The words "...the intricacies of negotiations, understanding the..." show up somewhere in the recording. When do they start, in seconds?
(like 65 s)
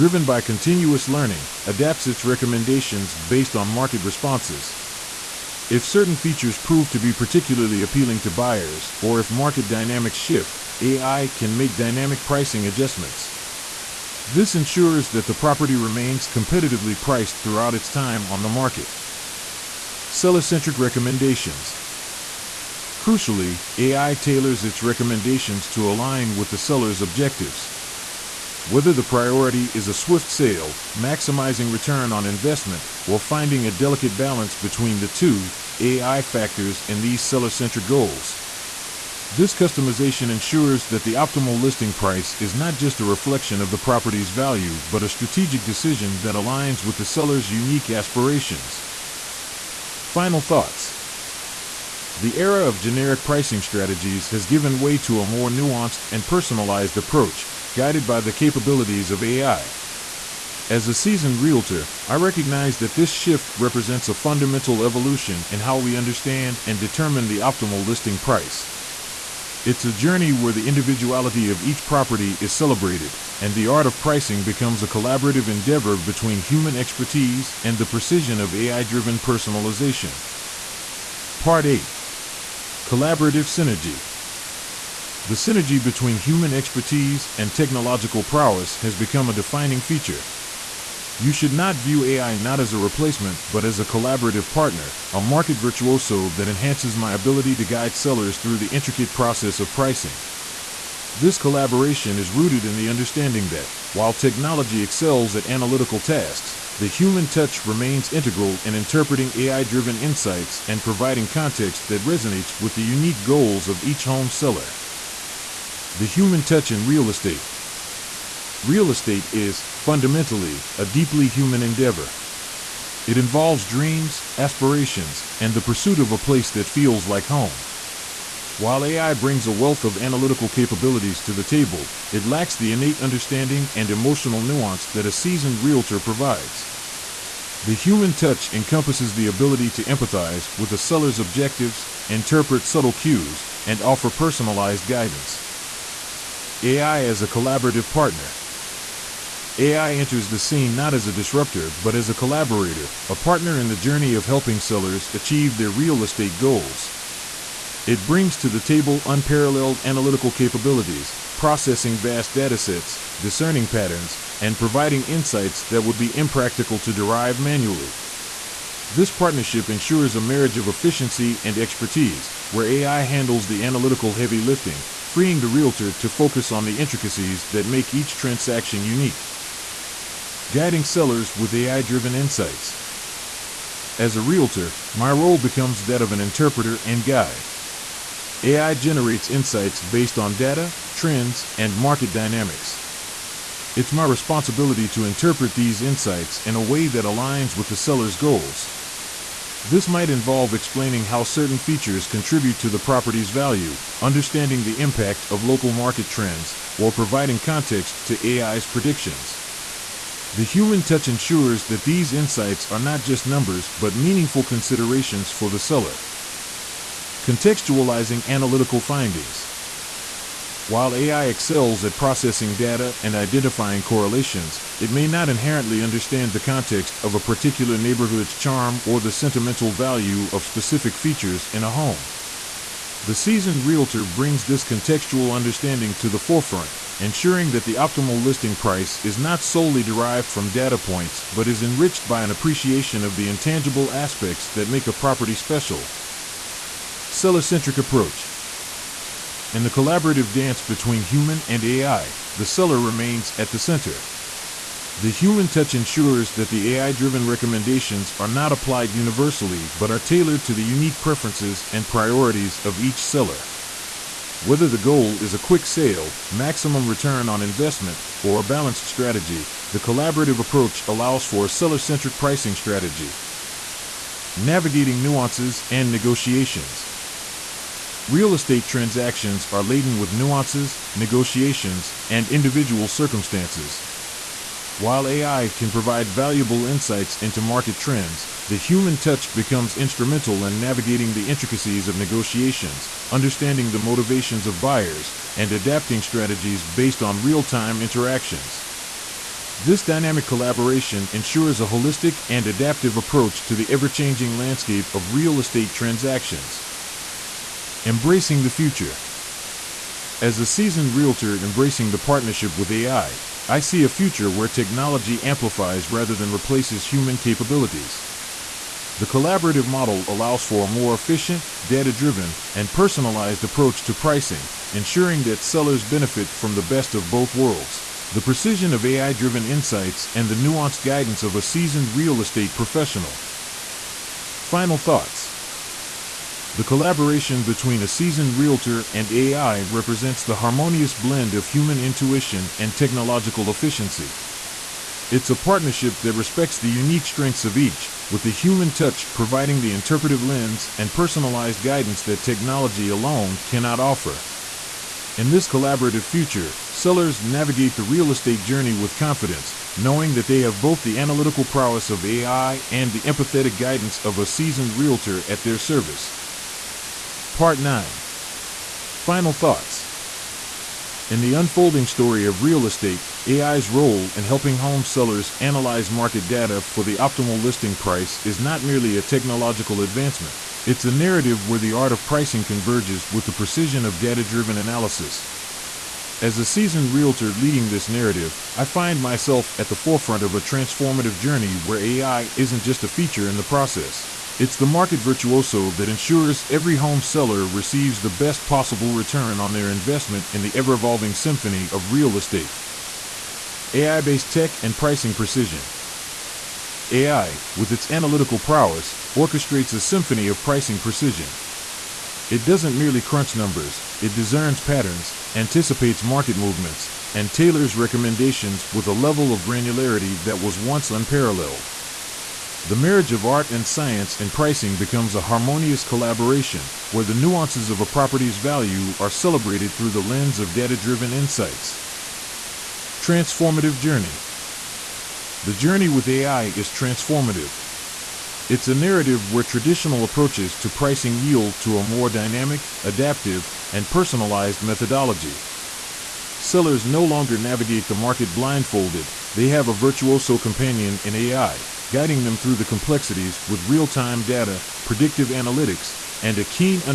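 291 s.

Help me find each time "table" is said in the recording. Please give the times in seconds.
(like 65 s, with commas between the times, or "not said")
131 s, 158 s.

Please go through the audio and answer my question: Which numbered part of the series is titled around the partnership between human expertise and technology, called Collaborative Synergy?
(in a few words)
Part 8.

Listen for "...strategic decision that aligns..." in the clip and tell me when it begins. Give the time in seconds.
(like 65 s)
45 s.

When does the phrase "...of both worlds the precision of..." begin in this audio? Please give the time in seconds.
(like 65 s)
326 s.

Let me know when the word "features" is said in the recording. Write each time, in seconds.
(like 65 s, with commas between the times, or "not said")
6 s, 89 s, 201 s, 230 s, 392 s.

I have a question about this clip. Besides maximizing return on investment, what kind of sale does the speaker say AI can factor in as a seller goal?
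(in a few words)
swift sale.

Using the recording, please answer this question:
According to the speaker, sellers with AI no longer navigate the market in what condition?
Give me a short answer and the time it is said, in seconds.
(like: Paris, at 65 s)
blindfolded, at 448 s.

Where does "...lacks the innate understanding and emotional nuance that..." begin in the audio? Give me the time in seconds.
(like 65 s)
132 s.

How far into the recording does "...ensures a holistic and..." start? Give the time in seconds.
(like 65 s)
301 s.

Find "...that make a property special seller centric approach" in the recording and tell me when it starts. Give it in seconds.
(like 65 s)
244 s.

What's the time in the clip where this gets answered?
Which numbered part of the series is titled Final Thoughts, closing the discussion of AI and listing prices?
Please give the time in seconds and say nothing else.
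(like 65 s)
367 s.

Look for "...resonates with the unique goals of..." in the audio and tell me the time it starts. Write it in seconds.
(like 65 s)
112 s.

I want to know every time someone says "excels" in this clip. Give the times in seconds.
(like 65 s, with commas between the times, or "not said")
104 s, 221 s.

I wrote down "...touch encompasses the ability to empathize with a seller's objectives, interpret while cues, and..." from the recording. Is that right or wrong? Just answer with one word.
wrong.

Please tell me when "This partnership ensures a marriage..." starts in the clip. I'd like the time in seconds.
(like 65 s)
168 s.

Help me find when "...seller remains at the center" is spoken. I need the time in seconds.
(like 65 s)
252 s.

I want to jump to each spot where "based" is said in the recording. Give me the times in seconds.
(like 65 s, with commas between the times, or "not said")
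3 s, 189 s, 296 s, 404 s.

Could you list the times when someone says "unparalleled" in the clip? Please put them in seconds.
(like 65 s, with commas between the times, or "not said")
159 s, 420 s.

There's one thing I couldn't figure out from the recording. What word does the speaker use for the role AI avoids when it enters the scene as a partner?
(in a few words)
disruptor.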